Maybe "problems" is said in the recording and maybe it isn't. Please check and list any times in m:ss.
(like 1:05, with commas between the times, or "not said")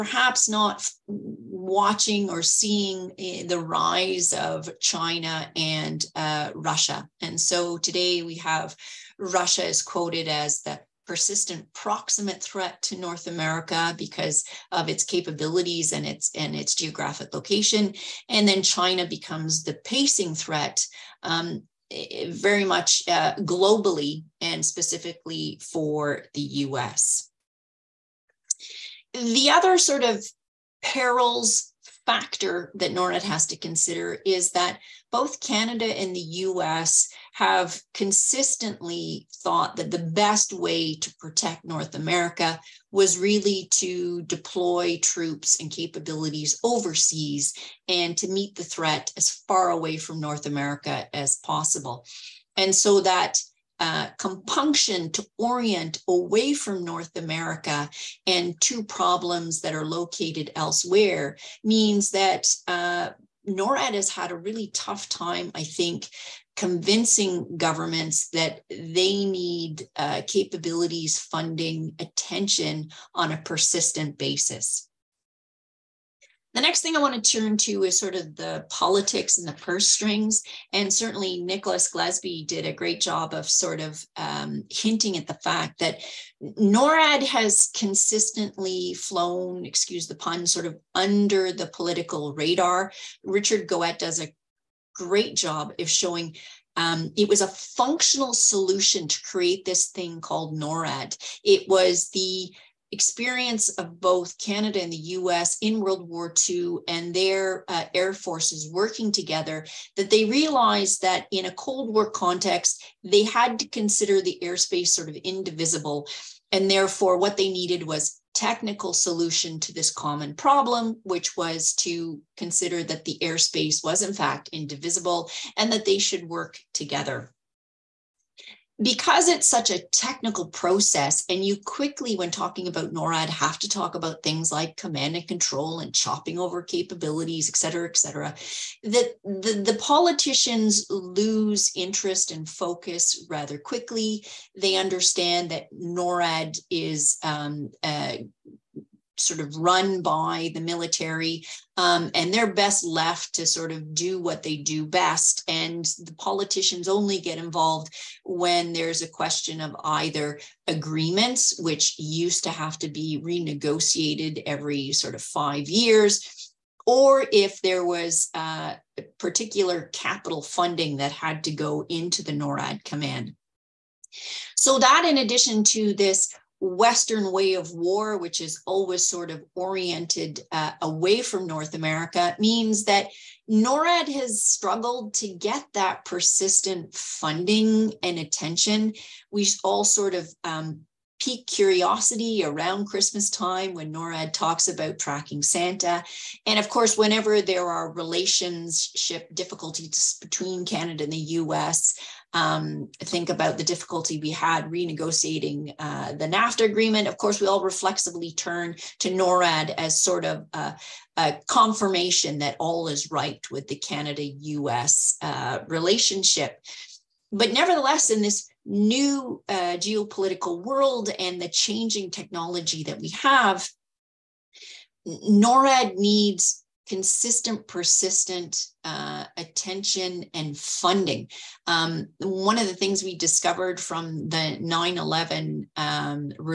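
0:58, 2:00.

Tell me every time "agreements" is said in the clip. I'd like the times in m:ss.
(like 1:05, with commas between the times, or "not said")
2:40, 3:26.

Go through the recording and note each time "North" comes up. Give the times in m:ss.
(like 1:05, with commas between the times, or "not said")
0:12, 0:41, 0:50, 0:56, 3:01.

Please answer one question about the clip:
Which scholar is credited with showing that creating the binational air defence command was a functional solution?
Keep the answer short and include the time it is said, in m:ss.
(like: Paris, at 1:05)
Richard Goette, at 1:33.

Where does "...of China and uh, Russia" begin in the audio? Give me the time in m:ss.
0:04.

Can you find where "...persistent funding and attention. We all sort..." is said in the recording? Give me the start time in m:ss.
3:06.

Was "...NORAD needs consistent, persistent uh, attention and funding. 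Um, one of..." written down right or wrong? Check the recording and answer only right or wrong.
right.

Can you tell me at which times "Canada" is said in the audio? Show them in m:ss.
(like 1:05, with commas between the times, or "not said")
0:35, 1:44, 3:20, 3:33.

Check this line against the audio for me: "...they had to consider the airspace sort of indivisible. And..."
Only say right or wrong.
right.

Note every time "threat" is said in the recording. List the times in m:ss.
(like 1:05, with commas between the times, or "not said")
0:12, 0:20, 0:48.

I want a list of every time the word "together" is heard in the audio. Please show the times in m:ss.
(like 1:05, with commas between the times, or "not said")
1:49, 2:06.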